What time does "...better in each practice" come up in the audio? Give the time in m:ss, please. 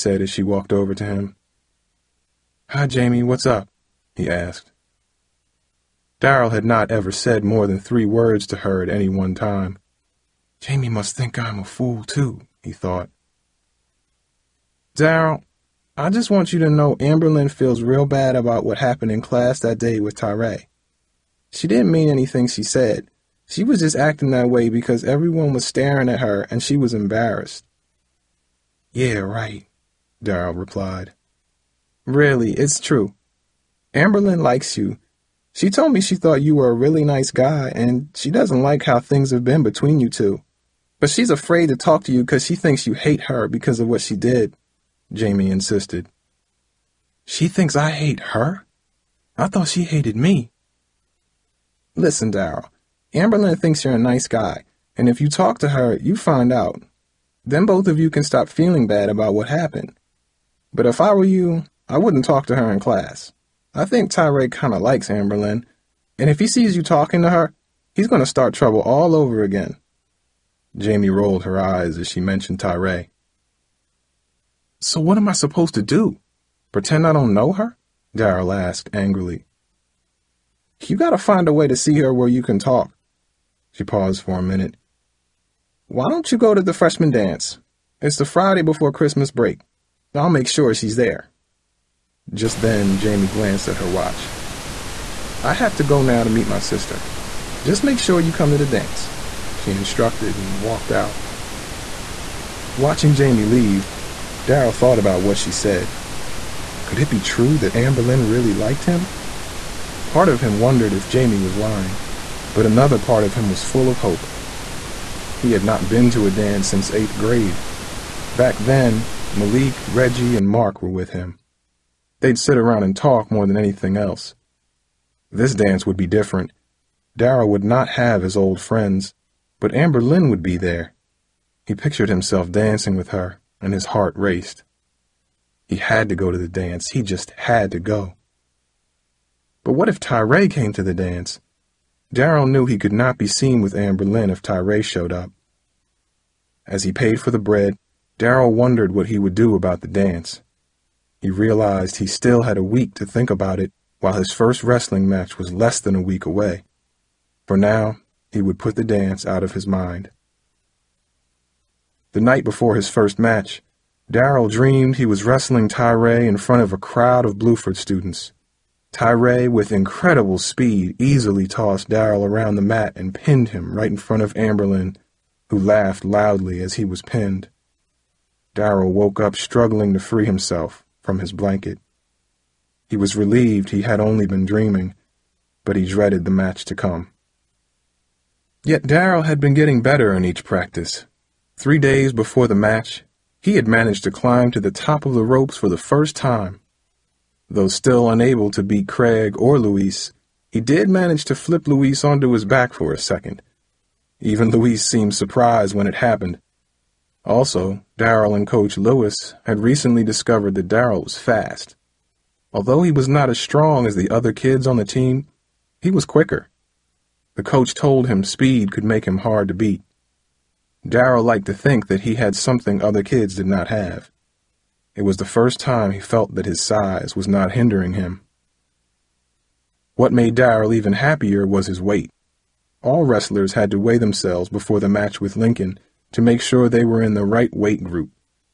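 3:09.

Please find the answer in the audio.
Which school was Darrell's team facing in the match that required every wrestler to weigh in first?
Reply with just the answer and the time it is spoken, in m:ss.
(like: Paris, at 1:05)
Lincoln, at 3:55.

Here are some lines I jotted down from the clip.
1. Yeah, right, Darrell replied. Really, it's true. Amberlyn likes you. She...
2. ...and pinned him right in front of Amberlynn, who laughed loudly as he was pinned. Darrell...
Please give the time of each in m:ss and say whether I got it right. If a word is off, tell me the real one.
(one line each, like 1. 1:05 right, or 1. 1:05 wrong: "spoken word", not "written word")
1. 0:28 right
2. 2:52 right.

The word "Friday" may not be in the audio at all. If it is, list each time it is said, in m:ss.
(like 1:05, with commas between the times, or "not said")
1:28.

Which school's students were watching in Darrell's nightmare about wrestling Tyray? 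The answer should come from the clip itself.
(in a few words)
Bluford.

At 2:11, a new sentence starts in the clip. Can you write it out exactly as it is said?
He pictured himself dancing with her, and his heart raced.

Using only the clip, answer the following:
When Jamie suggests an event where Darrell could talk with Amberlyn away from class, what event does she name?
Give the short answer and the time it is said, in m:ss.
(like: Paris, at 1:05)
freshman dance, at 1:26.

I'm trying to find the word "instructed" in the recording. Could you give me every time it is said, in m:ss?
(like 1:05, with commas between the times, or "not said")
1:39.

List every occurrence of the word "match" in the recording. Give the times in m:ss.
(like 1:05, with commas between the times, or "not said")
2:35, 2:43, 3:06, 3:12, 3:54.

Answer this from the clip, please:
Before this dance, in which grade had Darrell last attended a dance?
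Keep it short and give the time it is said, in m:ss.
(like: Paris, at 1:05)
eighth grade, at 1:56.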